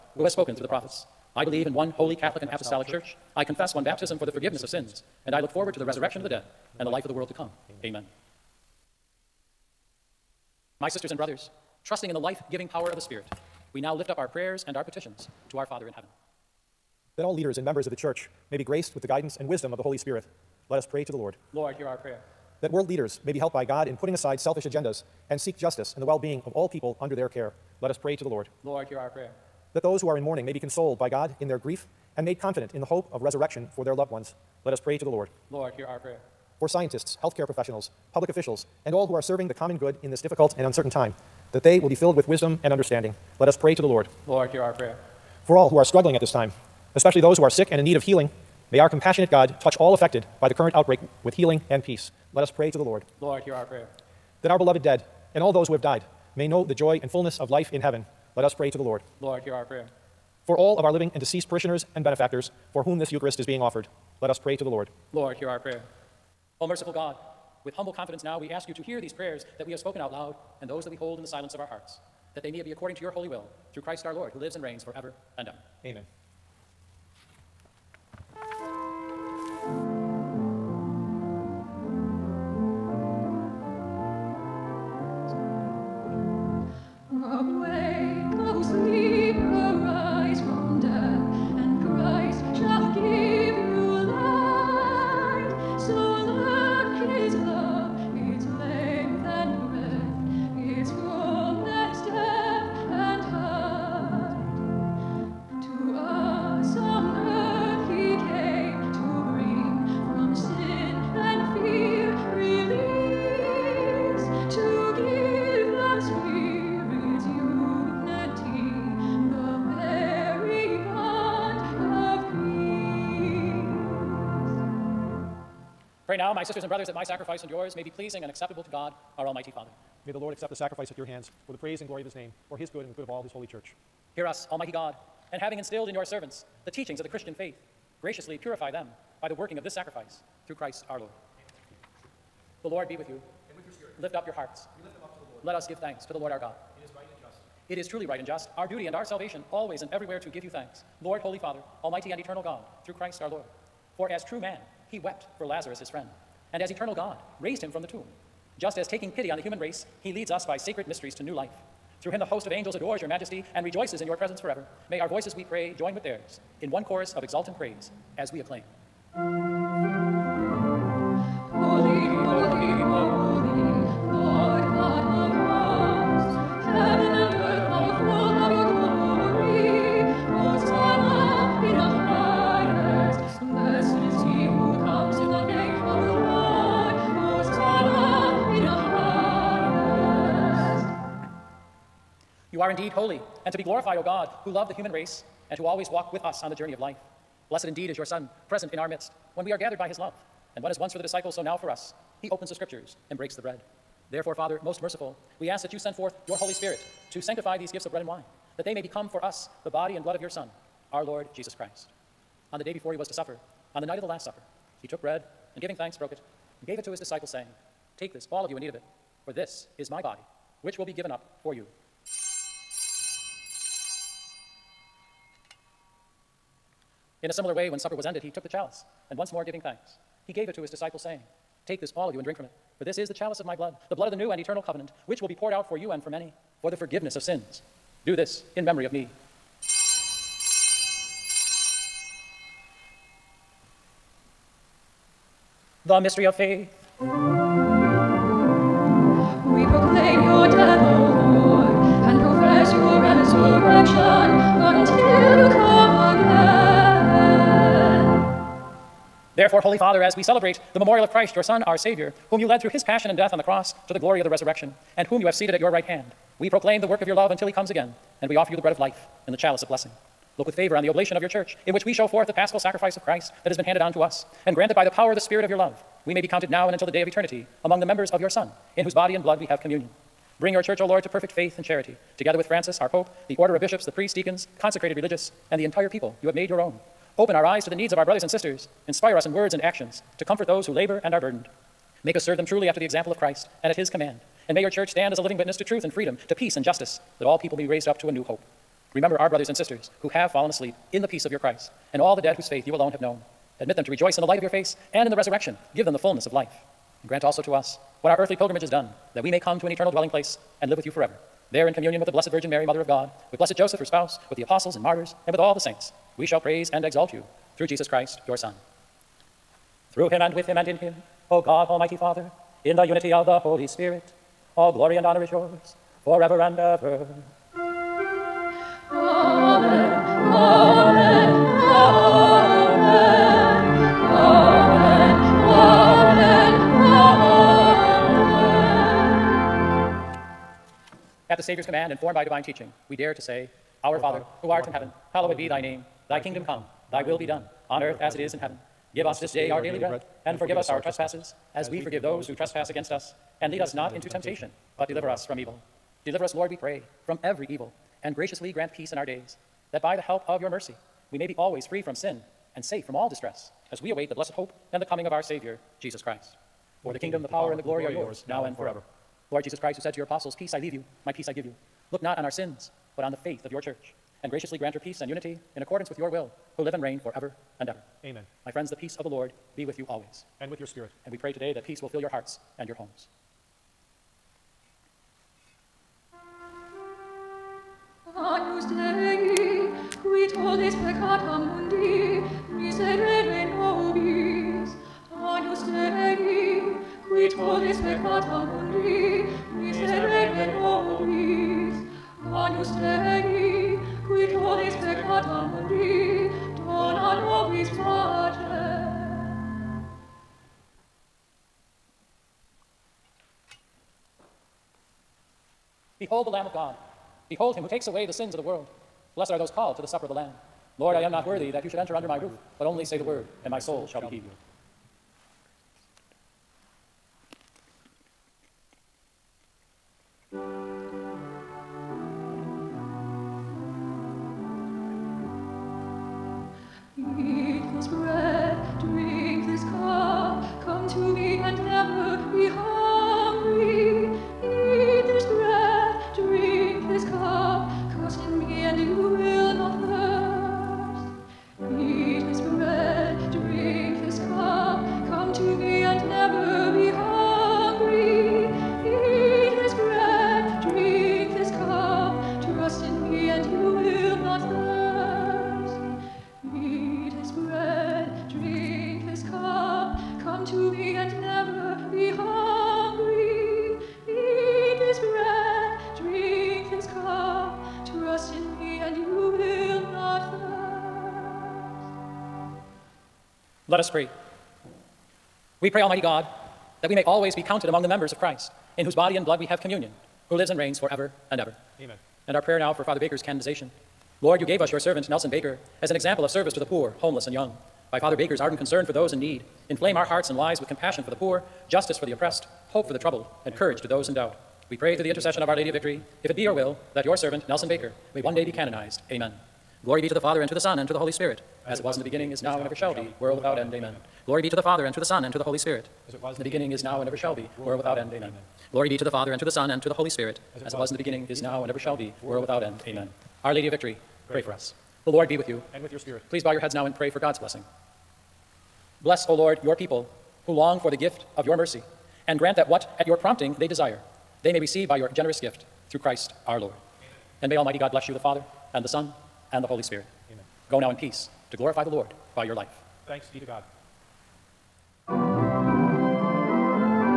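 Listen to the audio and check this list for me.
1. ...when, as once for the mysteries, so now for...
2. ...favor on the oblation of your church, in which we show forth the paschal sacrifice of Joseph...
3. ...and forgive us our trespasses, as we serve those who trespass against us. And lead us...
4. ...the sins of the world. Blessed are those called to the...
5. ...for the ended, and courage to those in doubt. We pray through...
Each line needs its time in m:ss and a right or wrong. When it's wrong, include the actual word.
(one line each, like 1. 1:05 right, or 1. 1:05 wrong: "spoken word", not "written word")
1. 3:20 wrong: "disciples", not "mysteries"
2. 4:30 wrong: "Christ", not "Joseph"
3. 5:50 wrong: "forgive", not "serve"
4. 6:58 right
5. 8:22 wrong: "troubled", not "ended".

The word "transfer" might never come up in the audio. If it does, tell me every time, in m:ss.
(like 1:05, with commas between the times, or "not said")
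not said.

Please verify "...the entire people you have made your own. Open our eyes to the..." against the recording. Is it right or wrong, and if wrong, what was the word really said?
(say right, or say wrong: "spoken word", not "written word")
right.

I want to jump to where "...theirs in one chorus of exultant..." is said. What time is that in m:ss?
2:46.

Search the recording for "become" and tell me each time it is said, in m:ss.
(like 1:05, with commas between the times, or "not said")
3:28.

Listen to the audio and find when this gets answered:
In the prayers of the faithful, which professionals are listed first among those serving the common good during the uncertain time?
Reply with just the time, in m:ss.
0:36.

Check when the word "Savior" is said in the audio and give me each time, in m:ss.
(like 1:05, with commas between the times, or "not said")
4:21, 5:41, 6:05.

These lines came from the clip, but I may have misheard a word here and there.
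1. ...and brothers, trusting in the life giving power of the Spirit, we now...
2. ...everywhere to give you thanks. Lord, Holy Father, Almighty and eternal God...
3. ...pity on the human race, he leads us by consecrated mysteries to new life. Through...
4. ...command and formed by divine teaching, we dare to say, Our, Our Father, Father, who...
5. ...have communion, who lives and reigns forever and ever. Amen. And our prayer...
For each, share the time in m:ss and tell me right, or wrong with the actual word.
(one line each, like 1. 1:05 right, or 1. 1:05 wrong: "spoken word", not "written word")
1. 0:11 right
2. 2:29 right
3. 2:39 wrong: "sacred", not "consecrated"
4. 5:41 right
5. 8:09 right.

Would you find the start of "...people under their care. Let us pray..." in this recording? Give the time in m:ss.
0:26.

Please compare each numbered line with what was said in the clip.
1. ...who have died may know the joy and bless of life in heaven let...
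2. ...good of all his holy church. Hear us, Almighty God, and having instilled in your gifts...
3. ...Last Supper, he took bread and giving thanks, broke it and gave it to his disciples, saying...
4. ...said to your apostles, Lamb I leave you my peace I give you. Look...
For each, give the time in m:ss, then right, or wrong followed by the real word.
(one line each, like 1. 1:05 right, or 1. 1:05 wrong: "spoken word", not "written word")
1. 0:55 wrong: "fullness", not "bless"
2. 2:12 wrong: "servants", not "gifts"
3. 3:34 right
4. 6:09 wrong: "Peace", not "Lamb".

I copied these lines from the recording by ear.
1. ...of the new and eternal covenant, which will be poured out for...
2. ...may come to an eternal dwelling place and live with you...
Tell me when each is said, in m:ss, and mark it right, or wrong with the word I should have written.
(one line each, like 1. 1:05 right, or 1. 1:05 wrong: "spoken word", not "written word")
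1. 3:54 right
2. 5:09 right.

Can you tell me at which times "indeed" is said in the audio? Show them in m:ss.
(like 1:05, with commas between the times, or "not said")
3:12, 3:17.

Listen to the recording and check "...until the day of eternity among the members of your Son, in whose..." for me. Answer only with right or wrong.
right.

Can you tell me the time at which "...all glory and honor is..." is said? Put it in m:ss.
5:24.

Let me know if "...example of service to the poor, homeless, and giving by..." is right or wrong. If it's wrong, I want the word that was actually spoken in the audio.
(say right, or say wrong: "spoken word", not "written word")
wrong: "young", not "giving".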